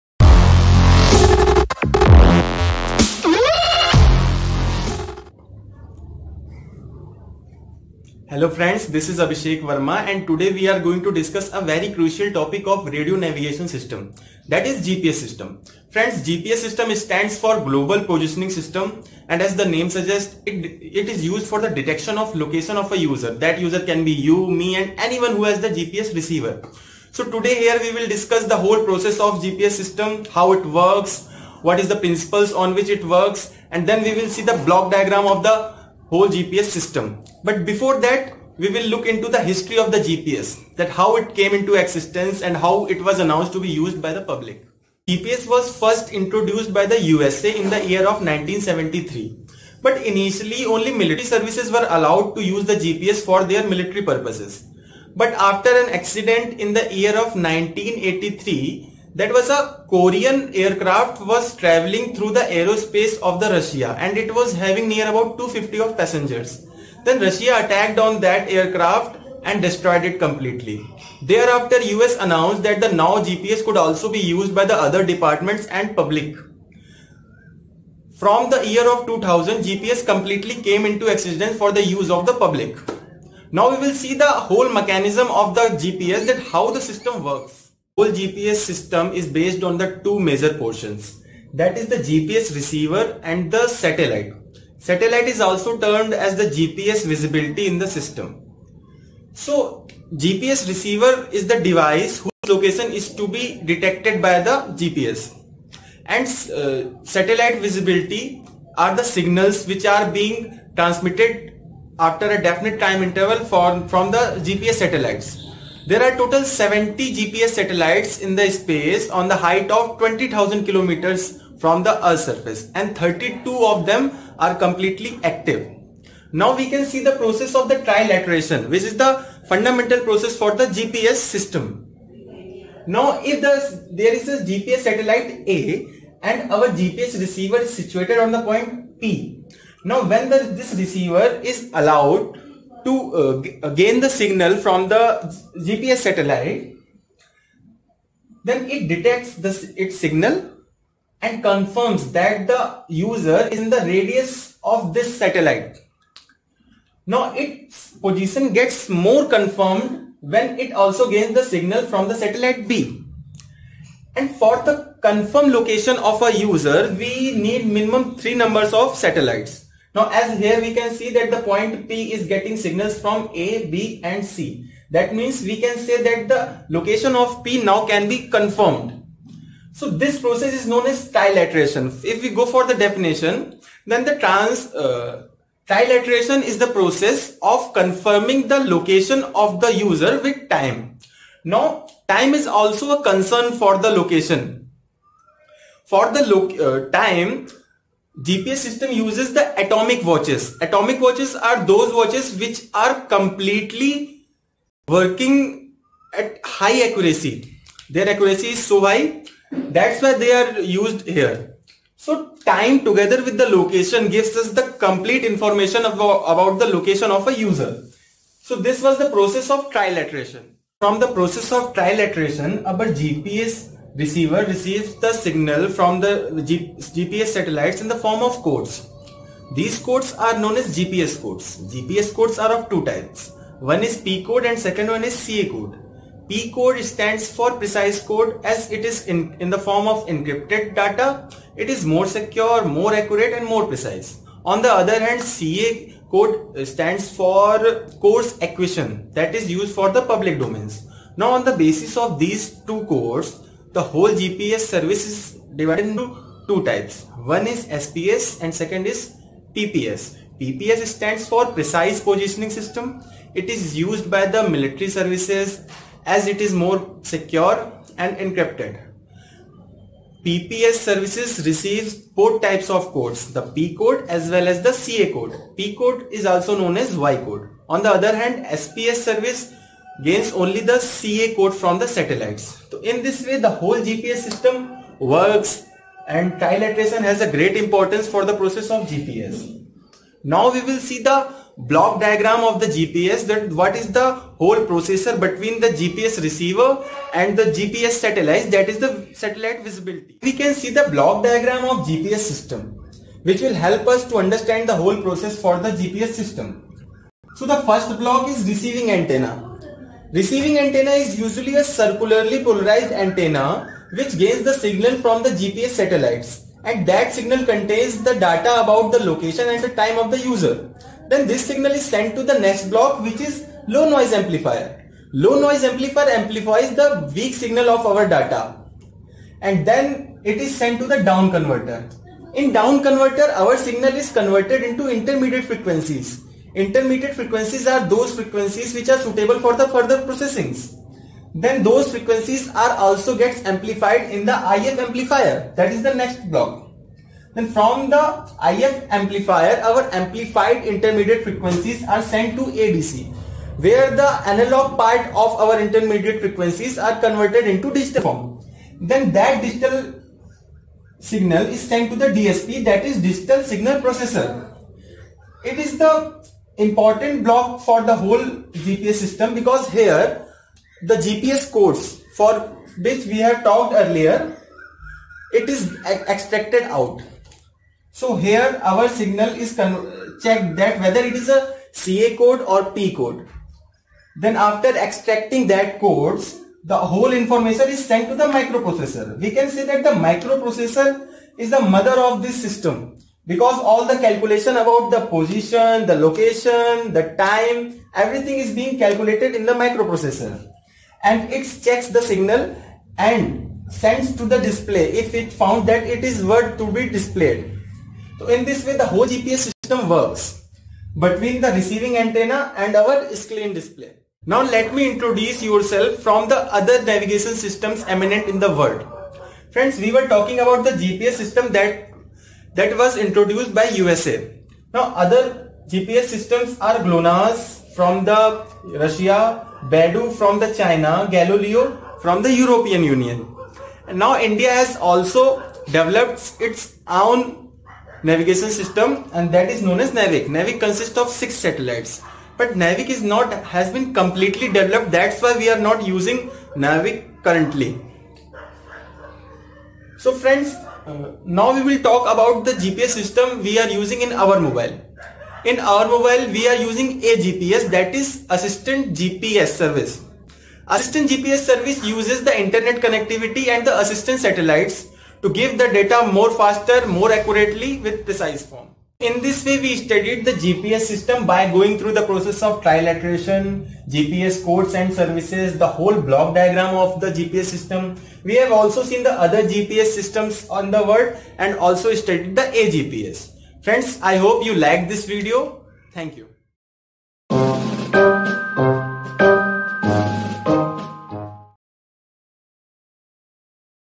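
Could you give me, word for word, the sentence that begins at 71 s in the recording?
Thereafter, US announced that the now GPS could also be used by the other departments and public.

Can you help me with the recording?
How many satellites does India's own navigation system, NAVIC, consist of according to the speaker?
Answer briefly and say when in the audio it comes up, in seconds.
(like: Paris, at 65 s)
6, at 441 s.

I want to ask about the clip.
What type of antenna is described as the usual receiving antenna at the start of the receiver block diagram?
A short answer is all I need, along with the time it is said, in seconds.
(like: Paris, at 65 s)
Circularly polarized antenna, at 311 s.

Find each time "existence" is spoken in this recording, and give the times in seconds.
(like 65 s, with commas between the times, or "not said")
41 s, 81 s.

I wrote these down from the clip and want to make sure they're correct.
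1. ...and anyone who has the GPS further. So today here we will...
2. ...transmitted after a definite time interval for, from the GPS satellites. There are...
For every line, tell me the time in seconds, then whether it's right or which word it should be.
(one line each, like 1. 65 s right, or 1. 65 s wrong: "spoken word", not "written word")
1. 24 s wrong: "receiver", not "further"
2. 110 s right.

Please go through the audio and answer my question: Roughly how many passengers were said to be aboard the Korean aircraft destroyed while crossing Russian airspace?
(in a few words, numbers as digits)
250.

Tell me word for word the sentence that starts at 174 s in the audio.
That means we can say that the location of P now can be confirmed.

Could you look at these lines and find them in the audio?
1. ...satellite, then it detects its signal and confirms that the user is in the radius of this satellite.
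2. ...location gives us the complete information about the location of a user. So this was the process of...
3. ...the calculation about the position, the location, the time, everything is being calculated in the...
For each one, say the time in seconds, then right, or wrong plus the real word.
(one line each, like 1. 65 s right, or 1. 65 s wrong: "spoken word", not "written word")
1. 145 s right
2. 213 s right
3. 393 s right.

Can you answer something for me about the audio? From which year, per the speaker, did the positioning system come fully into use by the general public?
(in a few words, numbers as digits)
2000.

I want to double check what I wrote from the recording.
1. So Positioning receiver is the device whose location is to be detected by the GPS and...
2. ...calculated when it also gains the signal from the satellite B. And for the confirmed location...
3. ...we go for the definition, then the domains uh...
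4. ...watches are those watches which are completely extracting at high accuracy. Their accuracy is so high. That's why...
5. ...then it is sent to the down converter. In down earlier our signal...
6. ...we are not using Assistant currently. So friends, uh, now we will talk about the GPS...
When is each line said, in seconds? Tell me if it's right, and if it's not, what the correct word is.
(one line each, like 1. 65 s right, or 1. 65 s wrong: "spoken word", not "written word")
1. 99 s wrong: "GPS", not "Positioning"
2. 159 s wrong: "confirmed", not "calculated"
3. 182 s wrong: "trans", not "domains"
4. 200 s wrong: "working", not "extracting"
5. 329 s wrong: "converter", not "earlier"
6. 445 s wrong: "NAVIC", not "Assistant".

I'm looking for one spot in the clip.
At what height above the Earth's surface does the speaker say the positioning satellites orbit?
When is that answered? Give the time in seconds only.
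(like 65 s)
119 s.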